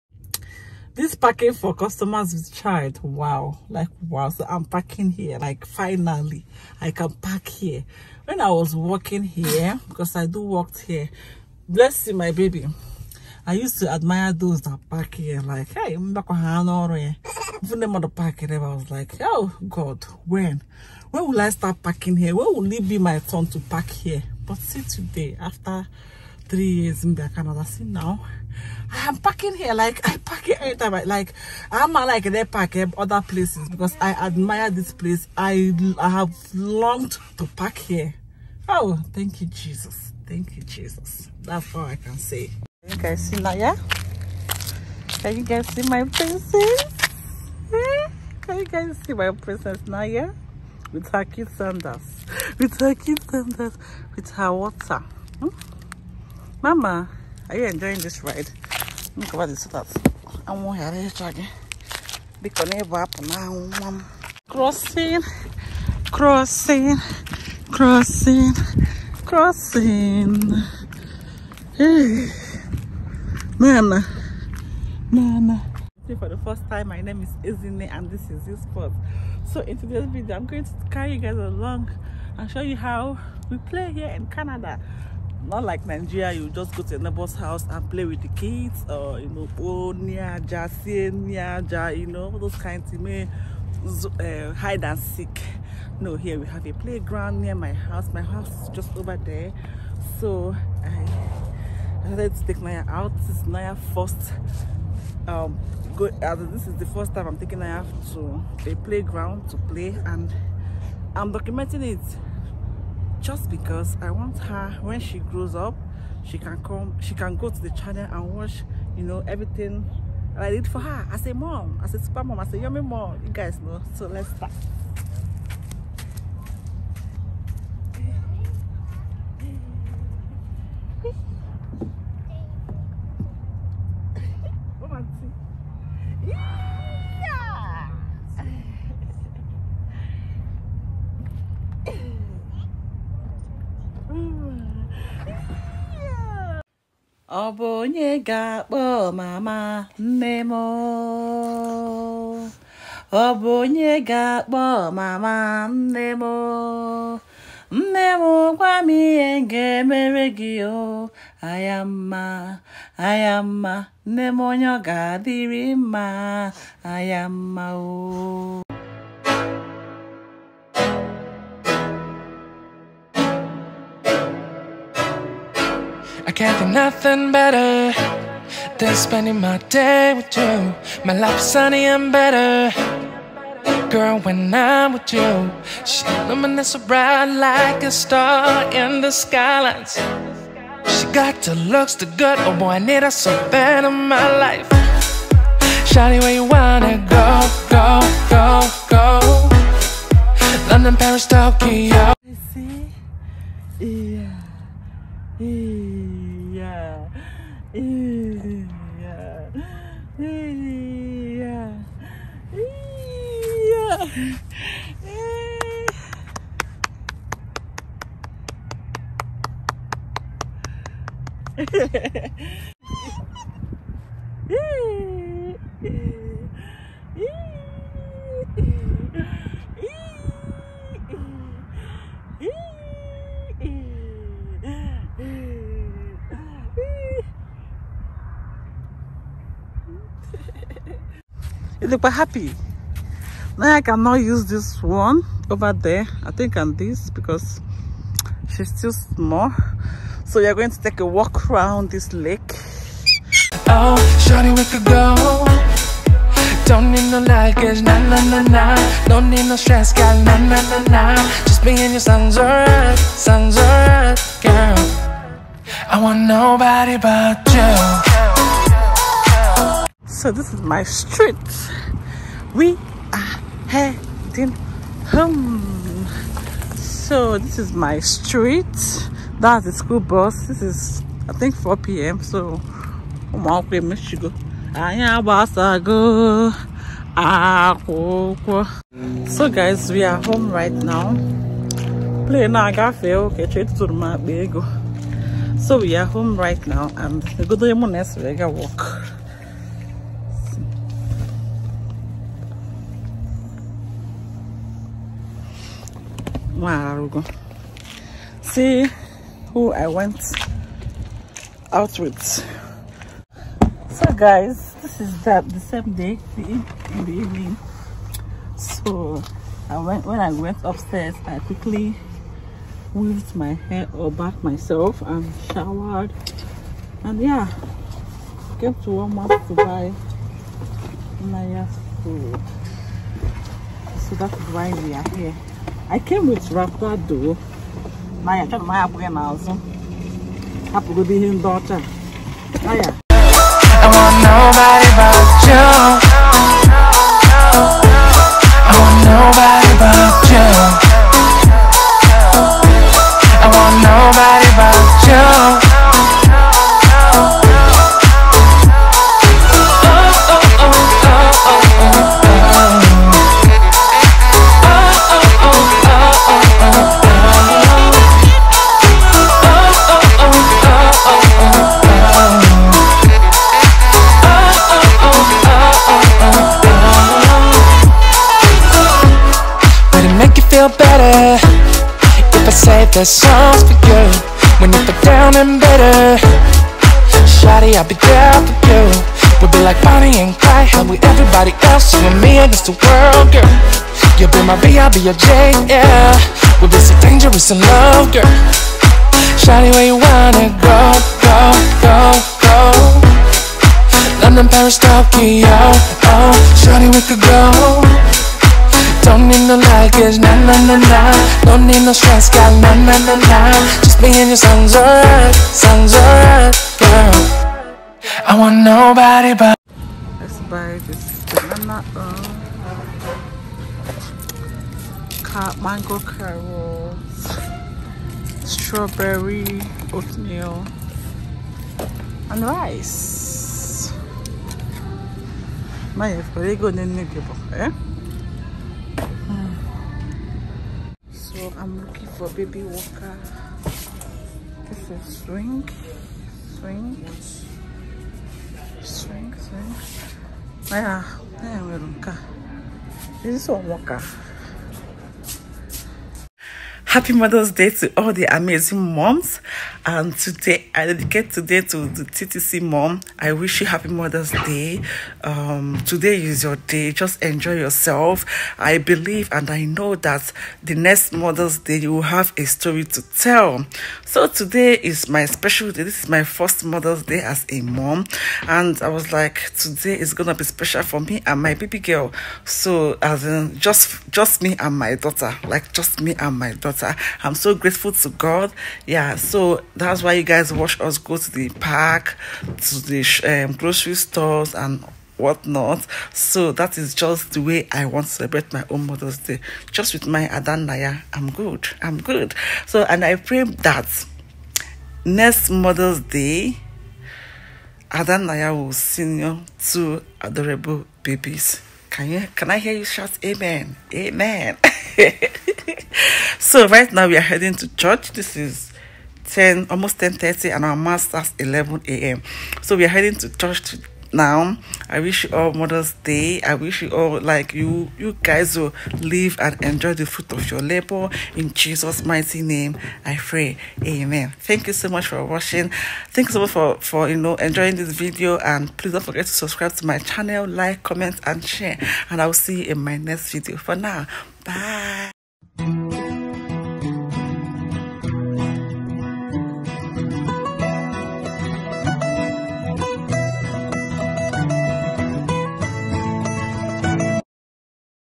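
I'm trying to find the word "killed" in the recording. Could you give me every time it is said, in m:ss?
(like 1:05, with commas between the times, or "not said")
not said.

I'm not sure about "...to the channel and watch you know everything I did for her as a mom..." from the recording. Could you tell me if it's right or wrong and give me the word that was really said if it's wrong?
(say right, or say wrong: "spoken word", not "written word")
right.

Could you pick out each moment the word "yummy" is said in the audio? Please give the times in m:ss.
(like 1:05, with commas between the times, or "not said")
2:02.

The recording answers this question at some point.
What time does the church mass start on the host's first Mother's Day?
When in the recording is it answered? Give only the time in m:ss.
8:41.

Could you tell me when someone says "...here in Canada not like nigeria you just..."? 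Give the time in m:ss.
1:23.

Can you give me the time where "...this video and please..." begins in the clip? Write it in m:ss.
8:57.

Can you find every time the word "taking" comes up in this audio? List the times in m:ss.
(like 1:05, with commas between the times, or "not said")
1:47.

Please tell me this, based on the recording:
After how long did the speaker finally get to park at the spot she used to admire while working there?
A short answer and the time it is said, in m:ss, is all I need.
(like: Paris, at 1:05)
3 years, at 0:26.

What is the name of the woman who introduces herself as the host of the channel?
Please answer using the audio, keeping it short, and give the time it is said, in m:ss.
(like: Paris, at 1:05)
Ezinne, at 1:17.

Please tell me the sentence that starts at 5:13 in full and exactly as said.
So guys, this is the, the same day in the evening.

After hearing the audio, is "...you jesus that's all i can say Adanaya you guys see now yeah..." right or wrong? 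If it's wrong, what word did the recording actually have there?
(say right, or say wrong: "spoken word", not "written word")
wrong: "Can", not "Adanaya".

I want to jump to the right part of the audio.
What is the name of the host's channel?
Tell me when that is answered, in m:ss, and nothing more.
1:18.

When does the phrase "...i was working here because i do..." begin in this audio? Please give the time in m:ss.
0:08.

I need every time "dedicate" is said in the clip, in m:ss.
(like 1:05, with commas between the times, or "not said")
7:40.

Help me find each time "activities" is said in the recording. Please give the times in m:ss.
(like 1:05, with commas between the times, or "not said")
not said.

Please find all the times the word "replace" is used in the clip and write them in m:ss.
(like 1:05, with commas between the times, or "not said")
not said.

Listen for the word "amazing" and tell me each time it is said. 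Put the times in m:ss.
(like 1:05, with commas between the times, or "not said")
7:38.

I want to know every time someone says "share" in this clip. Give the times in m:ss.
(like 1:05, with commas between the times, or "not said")
9:01.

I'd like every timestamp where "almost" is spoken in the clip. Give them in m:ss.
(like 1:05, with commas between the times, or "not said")
8:39.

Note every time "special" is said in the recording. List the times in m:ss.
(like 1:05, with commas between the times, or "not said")
7:55, 8:00.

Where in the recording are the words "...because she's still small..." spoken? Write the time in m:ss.
4:07.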